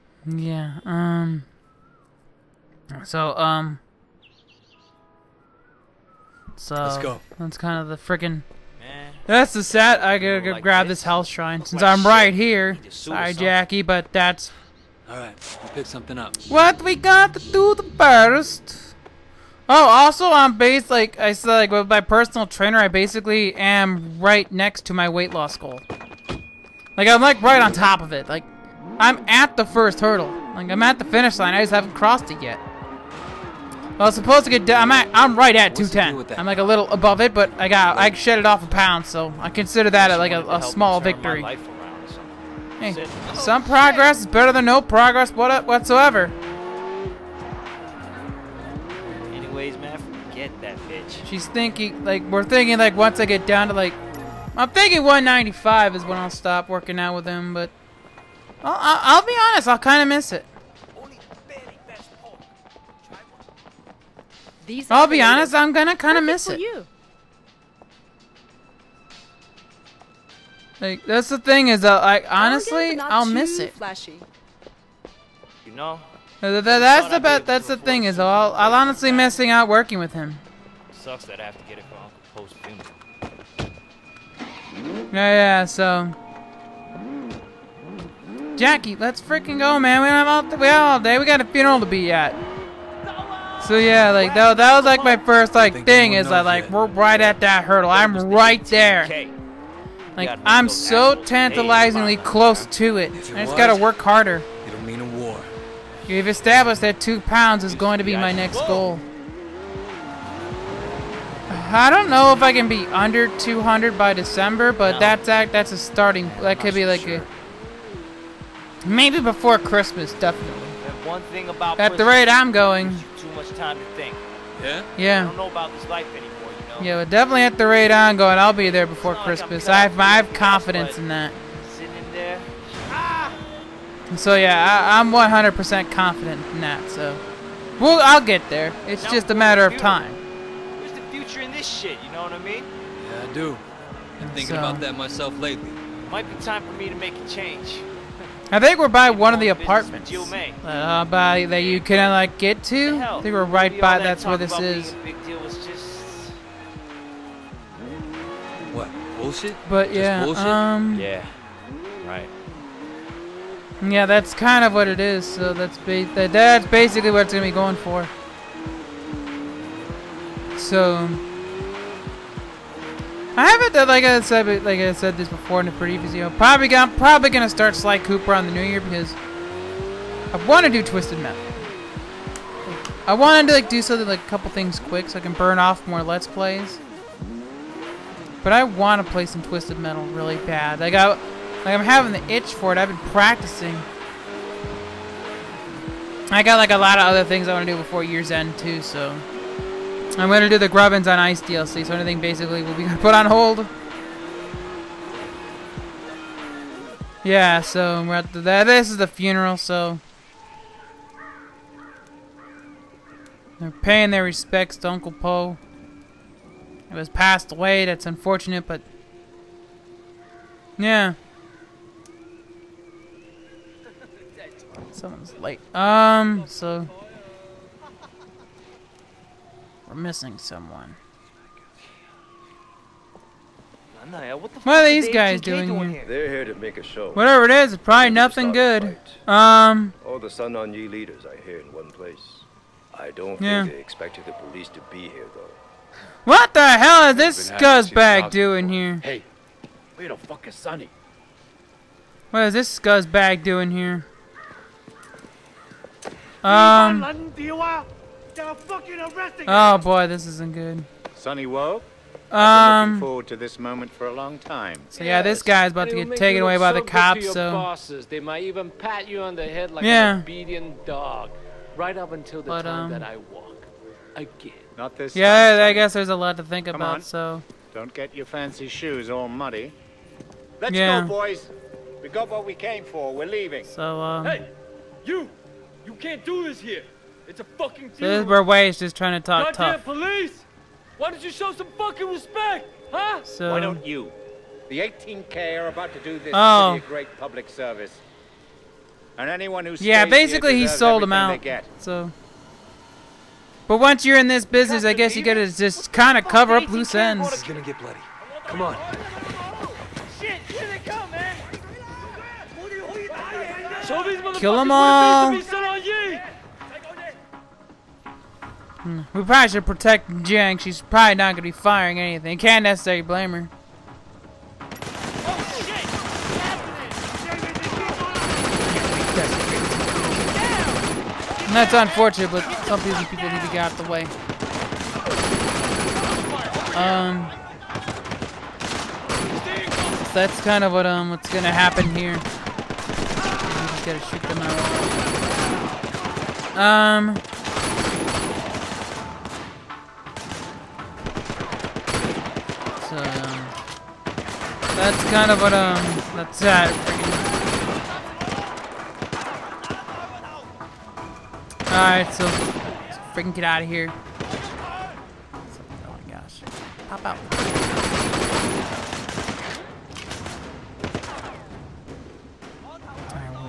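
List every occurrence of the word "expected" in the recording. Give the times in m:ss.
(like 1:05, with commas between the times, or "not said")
4:03.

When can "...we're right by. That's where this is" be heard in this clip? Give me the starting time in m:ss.
2:33.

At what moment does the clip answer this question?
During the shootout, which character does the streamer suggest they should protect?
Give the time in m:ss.
5:20.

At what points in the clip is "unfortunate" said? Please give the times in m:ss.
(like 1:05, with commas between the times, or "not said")
3:38, 5:31.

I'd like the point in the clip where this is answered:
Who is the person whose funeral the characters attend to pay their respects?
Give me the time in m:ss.
3:34.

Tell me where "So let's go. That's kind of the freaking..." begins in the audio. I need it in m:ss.
0:06.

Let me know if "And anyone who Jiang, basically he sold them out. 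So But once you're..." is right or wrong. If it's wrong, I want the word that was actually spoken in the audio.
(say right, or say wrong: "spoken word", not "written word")
wrong: "Yeah", not "Jiang".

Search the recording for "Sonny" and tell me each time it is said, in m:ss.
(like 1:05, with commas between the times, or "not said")
4:10, 4:21.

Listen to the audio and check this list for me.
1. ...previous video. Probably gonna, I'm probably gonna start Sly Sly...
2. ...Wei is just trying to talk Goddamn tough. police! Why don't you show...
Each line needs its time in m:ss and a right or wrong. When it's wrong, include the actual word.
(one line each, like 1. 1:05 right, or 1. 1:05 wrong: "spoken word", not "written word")
1. 2:55 wrong: "Cooper", not "Sly"
2. 4:48 right.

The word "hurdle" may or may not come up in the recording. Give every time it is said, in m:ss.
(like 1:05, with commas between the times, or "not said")
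0:30, 1:37.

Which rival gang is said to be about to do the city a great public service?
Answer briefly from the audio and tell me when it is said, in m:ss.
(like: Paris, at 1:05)
18K, at 4:54.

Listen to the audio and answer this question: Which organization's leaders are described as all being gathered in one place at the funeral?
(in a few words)
Sun On Yee.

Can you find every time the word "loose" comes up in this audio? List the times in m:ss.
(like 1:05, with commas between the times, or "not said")
5:06.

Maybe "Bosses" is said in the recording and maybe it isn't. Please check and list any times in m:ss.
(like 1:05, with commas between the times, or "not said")
4:27.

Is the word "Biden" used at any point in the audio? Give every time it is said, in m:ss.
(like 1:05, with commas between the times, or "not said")
not said.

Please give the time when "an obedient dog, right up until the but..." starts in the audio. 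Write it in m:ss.
4:30.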